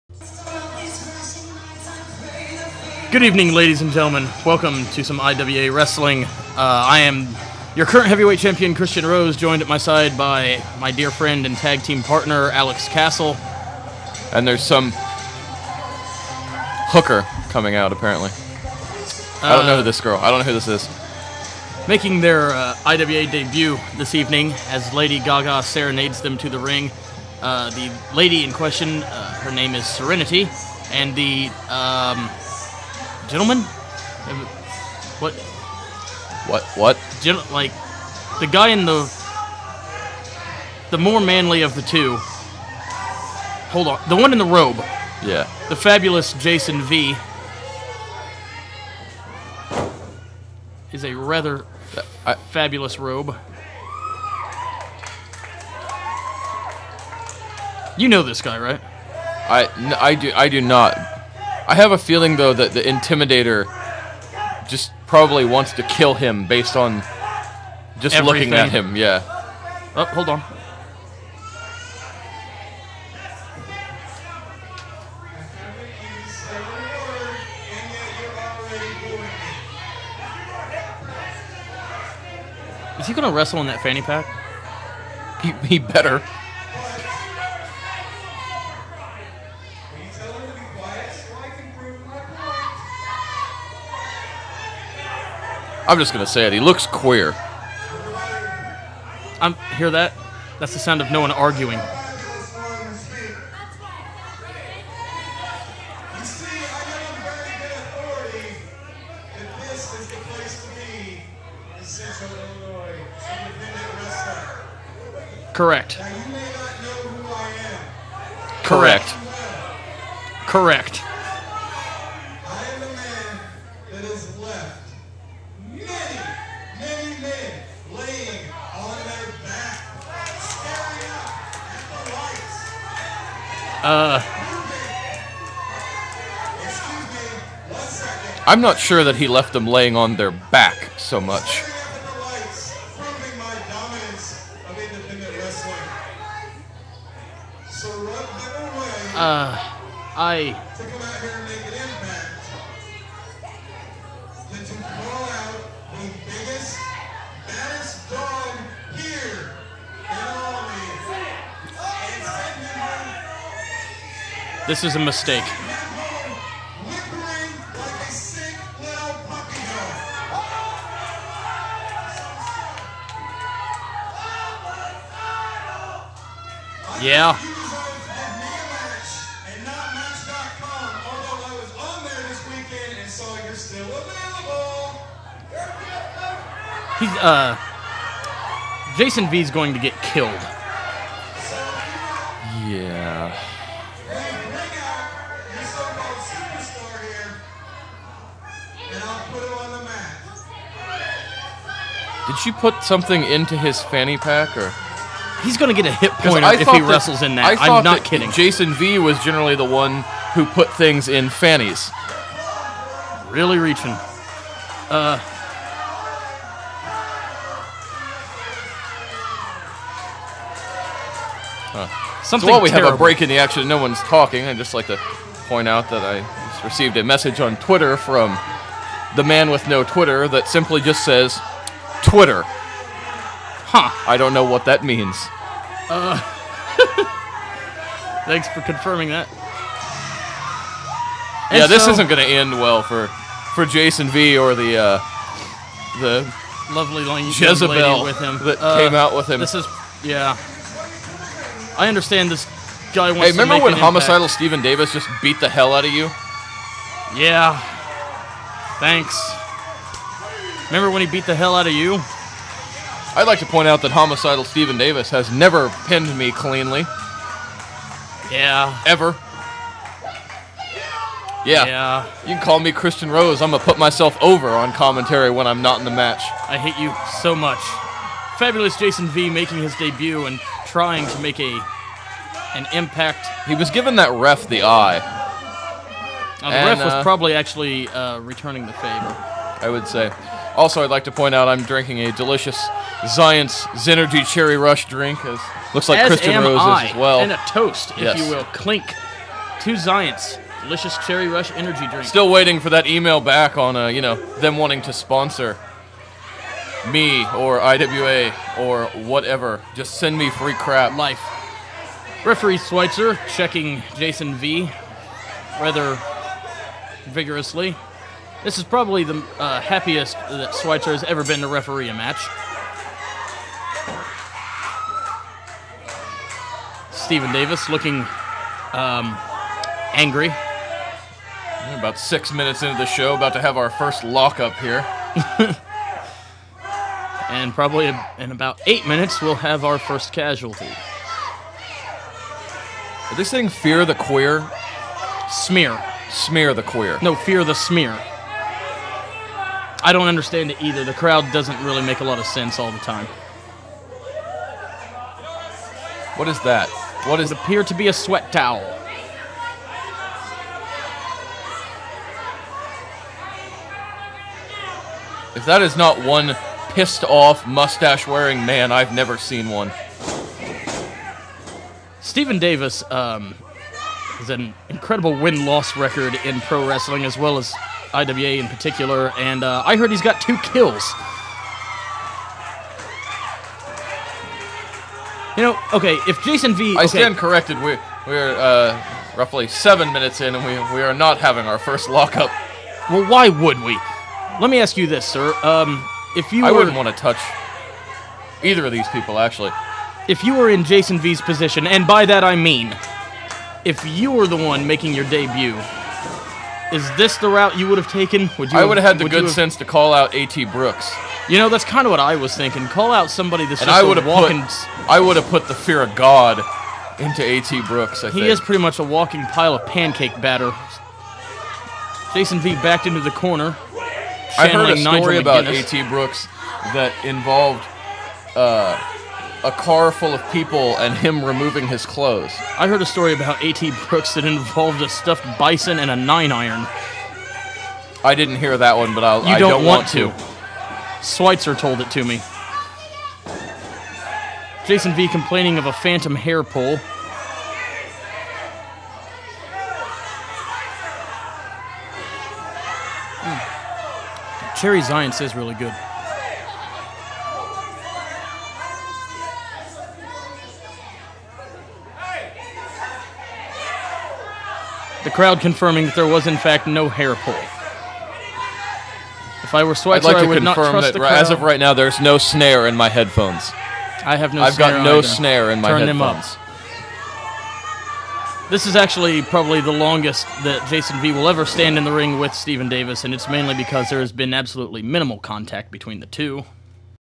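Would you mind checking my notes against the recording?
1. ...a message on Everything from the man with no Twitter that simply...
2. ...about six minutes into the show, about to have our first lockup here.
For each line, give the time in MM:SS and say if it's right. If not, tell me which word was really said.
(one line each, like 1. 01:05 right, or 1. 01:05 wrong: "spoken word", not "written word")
1. 03:46 wrong: "Twitter", not "Everything"
2. 05:31 right.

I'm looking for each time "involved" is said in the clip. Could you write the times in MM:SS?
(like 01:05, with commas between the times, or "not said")
07:07, 07:14.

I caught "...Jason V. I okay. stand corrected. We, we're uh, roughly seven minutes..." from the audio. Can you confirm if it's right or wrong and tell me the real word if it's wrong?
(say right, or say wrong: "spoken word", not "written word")
right.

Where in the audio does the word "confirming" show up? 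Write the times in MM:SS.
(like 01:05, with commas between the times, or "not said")
03:58, 07:45.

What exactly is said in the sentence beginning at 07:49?
If I were Schweitzer, like I would not trust that the crowd.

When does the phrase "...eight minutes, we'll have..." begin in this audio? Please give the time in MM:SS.
05:38.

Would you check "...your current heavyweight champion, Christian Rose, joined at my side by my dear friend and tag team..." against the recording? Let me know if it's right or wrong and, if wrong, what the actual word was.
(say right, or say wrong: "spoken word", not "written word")
right.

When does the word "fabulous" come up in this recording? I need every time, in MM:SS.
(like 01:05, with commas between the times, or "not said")
00:45, 00:52, 04:38.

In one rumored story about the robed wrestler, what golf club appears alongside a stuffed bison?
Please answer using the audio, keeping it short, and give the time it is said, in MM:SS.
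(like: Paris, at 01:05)
nine iron, at 07:15.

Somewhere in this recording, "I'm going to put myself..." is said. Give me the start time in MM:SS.
04:33.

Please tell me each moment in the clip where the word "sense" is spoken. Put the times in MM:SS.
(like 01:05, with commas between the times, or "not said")
05:52, 06:49.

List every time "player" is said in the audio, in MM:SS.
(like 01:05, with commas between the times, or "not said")
not said.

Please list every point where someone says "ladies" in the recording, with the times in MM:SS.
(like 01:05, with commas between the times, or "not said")
00:03.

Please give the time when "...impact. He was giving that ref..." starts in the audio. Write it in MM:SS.
04:42.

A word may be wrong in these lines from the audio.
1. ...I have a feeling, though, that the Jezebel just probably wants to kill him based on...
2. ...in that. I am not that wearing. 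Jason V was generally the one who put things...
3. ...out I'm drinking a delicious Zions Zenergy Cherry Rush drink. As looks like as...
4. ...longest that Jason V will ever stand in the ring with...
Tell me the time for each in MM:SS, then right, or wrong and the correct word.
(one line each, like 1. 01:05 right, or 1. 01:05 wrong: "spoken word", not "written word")
1. 01:01 wrong: "Intimidator", not "Jezebel"
2. 03:27 wrong: "kidding", not "wearing"
3. 04:51 right
4. 07:59 right.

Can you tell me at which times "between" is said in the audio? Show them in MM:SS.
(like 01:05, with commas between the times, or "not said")
08:05.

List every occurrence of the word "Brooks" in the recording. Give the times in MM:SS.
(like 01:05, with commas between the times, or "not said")
06:50, 06:57, 07:05, 07:13.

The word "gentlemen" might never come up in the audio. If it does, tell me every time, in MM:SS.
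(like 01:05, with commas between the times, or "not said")
00:03, 00:33.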